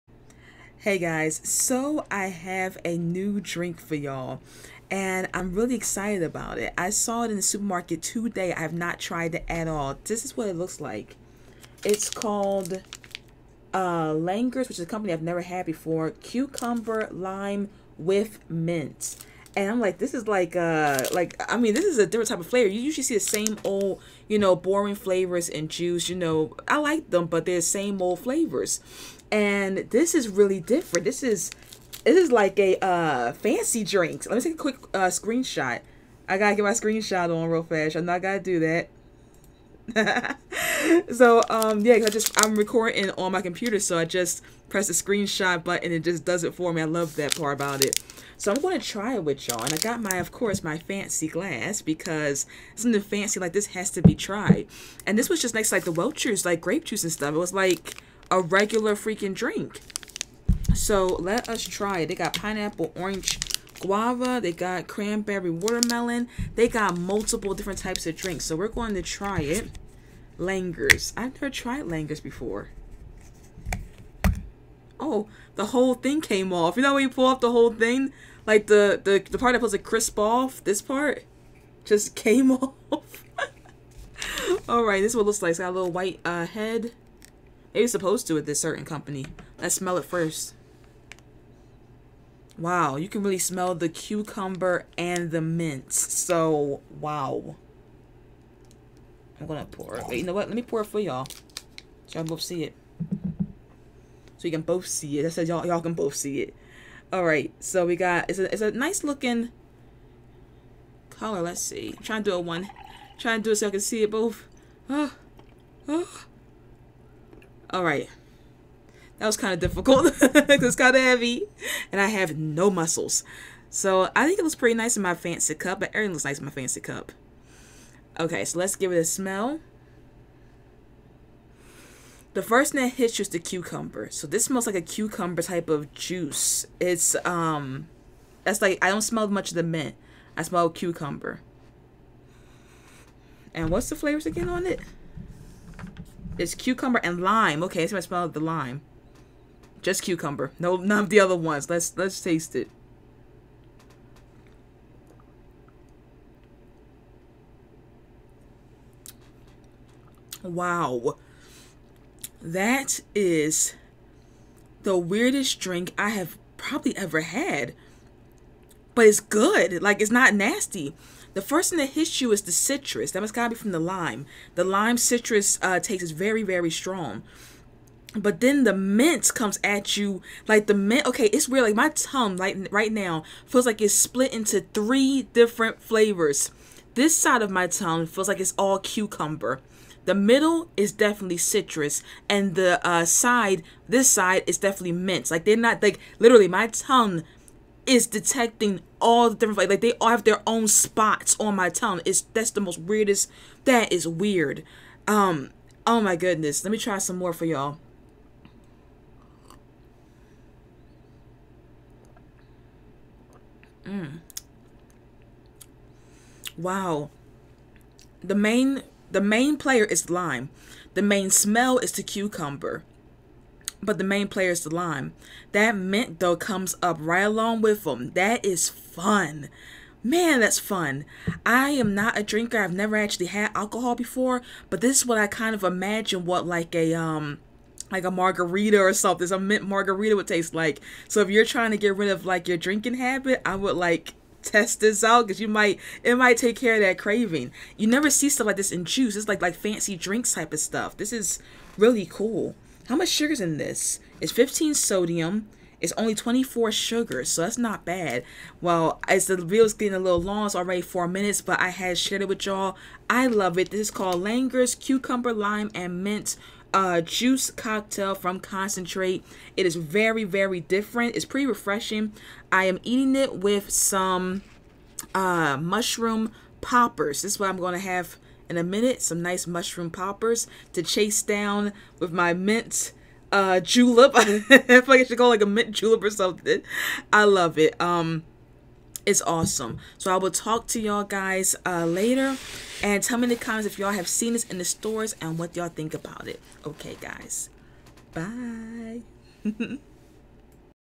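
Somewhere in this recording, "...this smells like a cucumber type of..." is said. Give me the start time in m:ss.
2:14.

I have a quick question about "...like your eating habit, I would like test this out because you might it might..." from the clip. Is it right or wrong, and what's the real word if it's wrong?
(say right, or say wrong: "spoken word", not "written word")
wrong: "drinking", not "eating".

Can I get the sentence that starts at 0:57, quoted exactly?
It was like a regular freaking drink.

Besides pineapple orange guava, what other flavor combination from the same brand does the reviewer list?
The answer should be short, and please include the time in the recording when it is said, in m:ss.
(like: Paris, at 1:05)
cranberry watermelon, at 1:04.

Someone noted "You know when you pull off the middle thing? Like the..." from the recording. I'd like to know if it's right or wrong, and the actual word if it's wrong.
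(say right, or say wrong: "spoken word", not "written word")
wrong: "whole", not "middle".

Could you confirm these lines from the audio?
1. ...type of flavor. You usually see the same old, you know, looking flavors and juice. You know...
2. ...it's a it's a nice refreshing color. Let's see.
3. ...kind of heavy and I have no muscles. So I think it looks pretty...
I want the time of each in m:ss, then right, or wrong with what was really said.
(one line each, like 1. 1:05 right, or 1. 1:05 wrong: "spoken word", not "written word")
1. 0:22 wrong: "boring", not "looking"
2. 1:48 wrong: "looking", not "refreshing"
3. 2:00 right.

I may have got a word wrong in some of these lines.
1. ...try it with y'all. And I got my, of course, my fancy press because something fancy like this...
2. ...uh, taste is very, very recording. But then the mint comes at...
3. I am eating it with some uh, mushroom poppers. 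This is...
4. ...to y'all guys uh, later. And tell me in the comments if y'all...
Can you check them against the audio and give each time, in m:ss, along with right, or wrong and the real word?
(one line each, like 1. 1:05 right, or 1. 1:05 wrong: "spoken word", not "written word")
1. 0:48 wrong: "glass", not "press"
2. 2:55 wrong: "strong", not "recording"
3. 4:32 right
4. 4:50 right.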